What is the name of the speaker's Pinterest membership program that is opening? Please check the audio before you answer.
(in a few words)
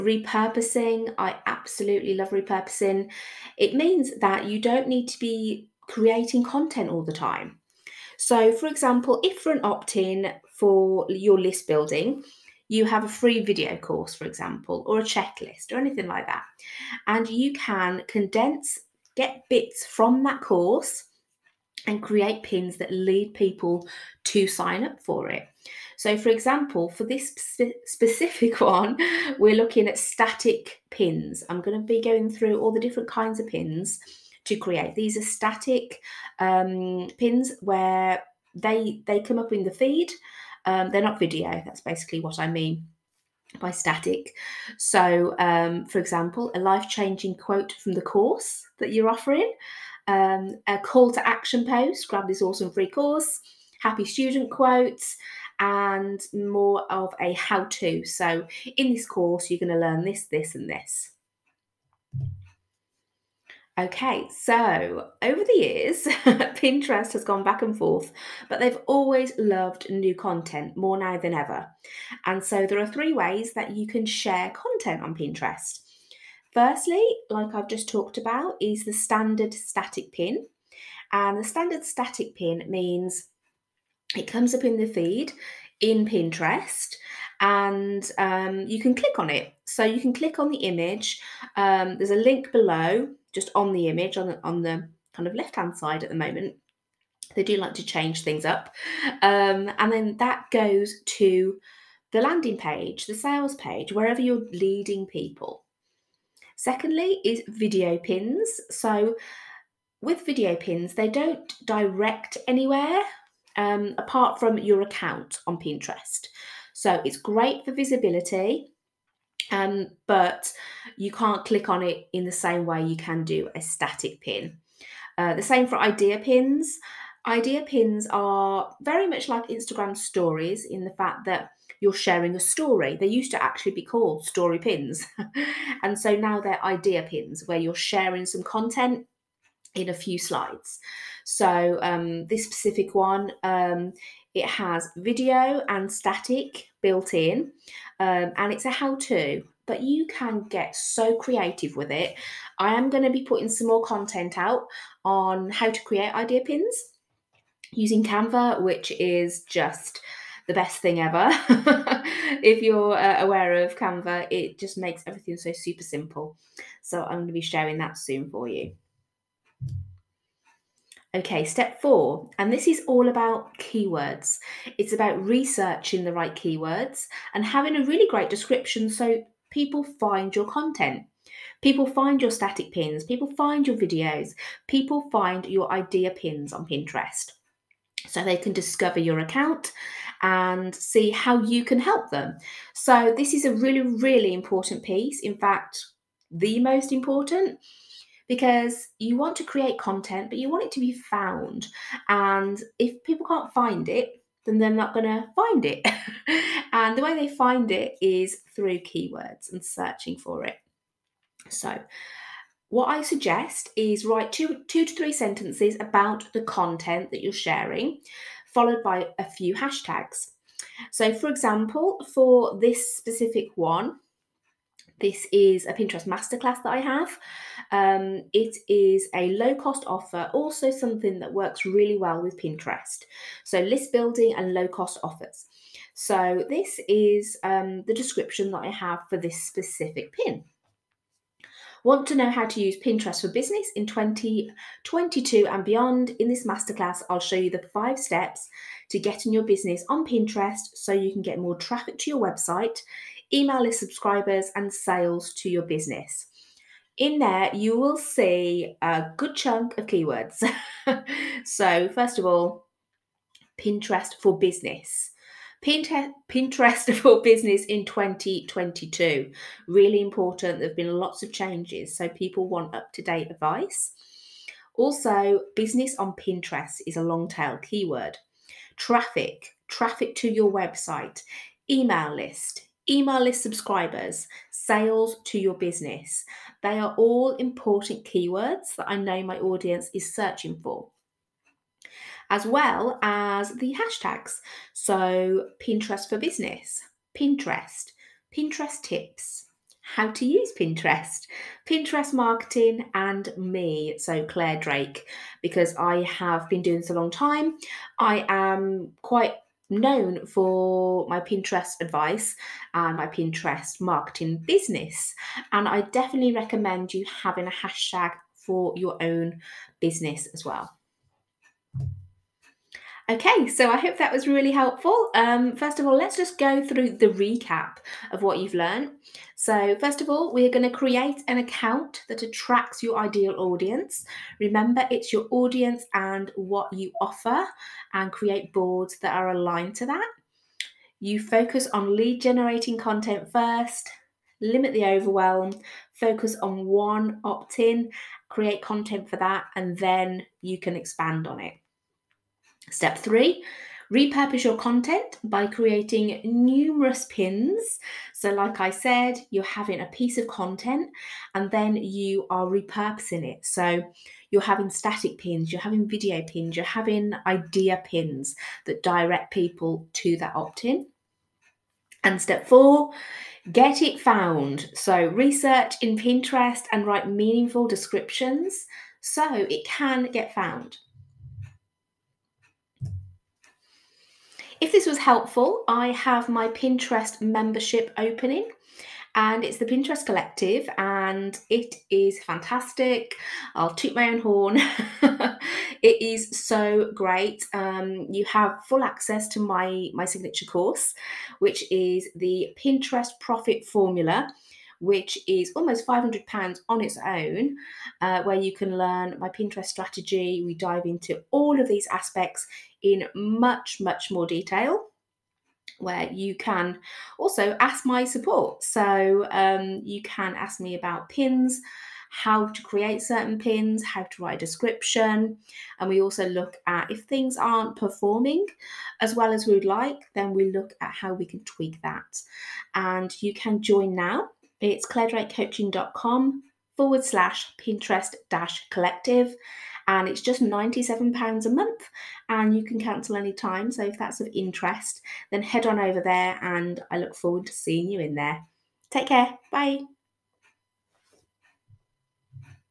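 The Pinterest Collective.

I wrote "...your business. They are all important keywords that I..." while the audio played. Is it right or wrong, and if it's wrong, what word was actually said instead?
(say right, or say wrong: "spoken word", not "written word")
right.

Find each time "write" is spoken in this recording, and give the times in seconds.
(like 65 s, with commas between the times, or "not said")
214 s, 376 s, 424 s.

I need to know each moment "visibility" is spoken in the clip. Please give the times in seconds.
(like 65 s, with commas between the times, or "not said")
117 s.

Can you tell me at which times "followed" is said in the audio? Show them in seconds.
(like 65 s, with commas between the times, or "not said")
218 s.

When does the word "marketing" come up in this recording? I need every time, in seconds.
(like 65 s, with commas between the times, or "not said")
302 s, 313 s.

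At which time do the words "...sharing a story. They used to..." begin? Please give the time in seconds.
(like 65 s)
131 s.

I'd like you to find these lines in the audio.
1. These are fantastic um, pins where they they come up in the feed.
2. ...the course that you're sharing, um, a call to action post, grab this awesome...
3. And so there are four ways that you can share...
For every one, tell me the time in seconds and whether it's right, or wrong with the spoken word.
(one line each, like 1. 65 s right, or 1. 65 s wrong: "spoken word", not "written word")
1. 34 s wrong: "static", not "fantastic"
2. 47 s wrong: "offering", not "sharing"
3. 72 s wrong: "three", not "four".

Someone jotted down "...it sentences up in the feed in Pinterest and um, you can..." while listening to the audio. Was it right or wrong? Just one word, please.
wrong.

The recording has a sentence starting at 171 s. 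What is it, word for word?
Okay, step four, and this is all about keywords.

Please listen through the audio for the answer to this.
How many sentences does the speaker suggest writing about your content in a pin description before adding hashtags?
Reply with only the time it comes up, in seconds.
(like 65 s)
214 s.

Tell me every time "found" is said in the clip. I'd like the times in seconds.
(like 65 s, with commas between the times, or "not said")
200 s, 373 s, 380 s.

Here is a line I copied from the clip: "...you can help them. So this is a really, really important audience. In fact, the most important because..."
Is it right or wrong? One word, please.
wrong.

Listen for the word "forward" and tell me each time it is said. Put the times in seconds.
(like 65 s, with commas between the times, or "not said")
436 s, 447 s.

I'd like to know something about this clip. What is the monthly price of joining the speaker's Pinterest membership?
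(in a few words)
£97.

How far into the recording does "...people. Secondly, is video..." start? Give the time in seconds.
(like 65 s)
105 s.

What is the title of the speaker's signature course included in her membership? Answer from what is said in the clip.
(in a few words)
Pinterest Profit Formula.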